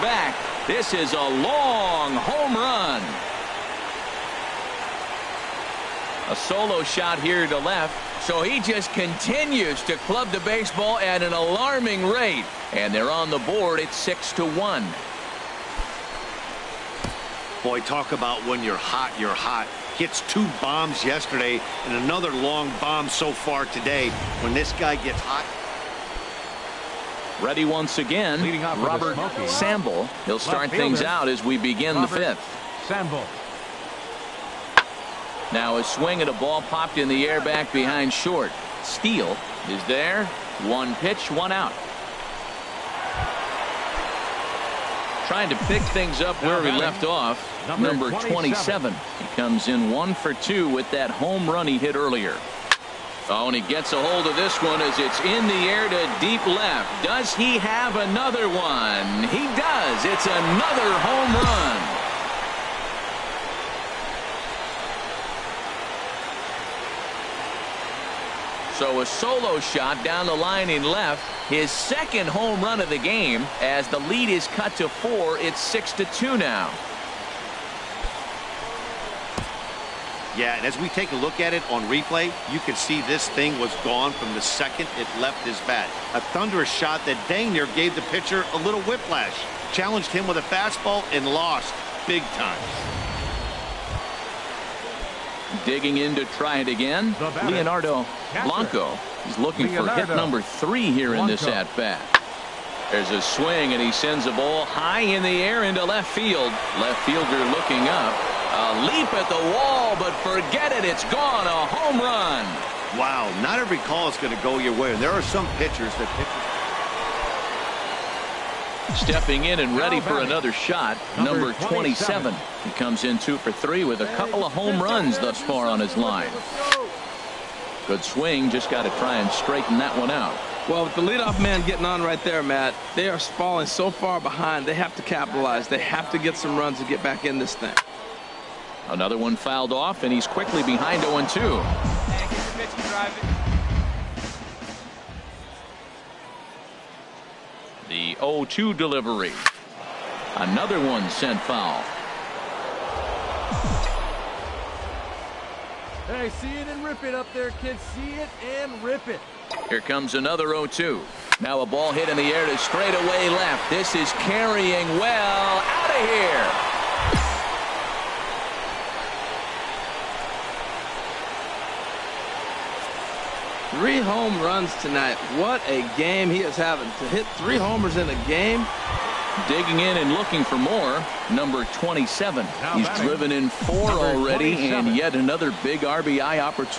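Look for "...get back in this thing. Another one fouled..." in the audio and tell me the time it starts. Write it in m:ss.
2:16.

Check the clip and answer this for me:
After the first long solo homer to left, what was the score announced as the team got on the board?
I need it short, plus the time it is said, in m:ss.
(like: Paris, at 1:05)
6 to 1, at 0:13.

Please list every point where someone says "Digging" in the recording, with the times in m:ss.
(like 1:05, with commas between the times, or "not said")
1:35, 2:59.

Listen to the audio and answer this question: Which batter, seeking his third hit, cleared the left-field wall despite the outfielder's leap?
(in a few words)
Leonardo Blanco.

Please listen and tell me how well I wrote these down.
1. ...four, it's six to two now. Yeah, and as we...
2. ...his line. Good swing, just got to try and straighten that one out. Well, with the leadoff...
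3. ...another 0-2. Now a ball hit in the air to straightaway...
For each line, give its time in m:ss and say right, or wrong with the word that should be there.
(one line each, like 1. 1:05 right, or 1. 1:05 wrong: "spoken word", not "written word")
1. 1:14 right
2. 2:05 right
3. 2:40 right.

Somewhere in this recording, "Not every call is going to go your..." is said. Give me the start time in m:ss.
1:53.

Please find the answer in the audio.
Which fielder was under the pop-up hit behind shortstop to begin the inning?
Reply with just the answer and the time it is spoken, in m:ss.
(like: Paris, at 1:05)
Steele, at 0:38.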